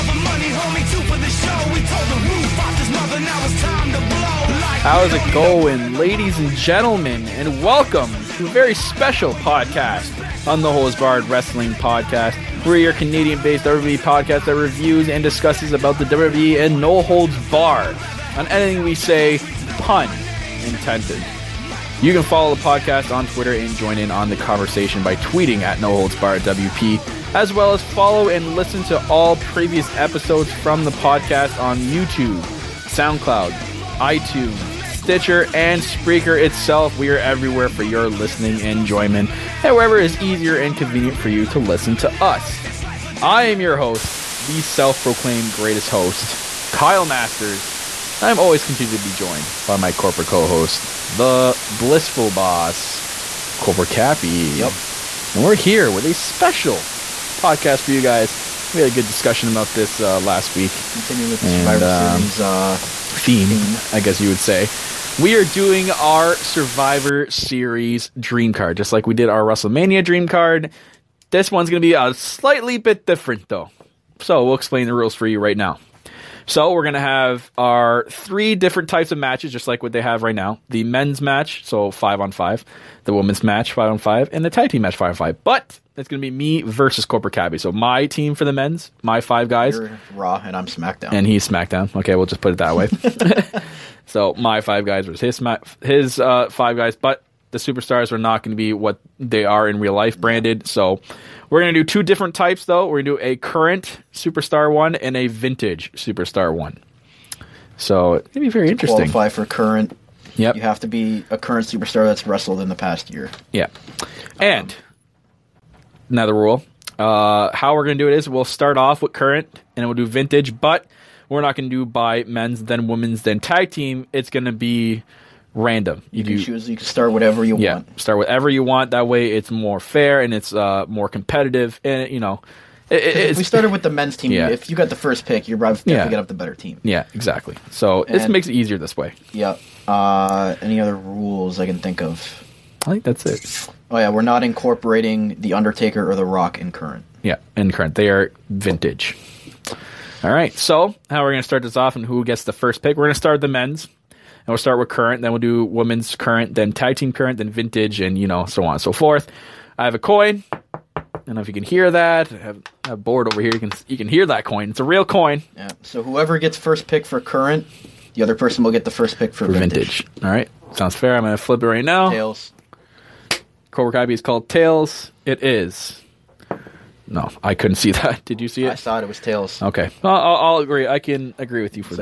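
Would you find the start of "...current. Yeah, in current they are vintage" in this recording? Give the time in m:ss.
2:26.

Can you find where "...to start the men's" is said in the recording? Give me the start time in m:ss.
2:33.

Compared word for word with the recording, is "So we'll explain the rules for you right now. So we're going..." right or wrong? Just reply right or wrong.
right.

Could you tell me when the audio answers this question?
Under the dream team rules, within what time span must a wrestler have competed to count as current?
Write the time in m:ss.
1:52.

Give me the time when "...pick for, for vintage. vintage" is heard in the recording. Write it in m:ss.
2:49.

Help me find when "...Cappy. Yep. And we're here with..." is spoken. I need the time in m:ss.
0:53.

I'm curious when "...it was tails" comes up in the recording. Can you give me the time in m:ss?
2:59.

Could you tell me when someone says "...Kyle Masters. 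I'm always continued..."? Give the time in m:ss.
0:46.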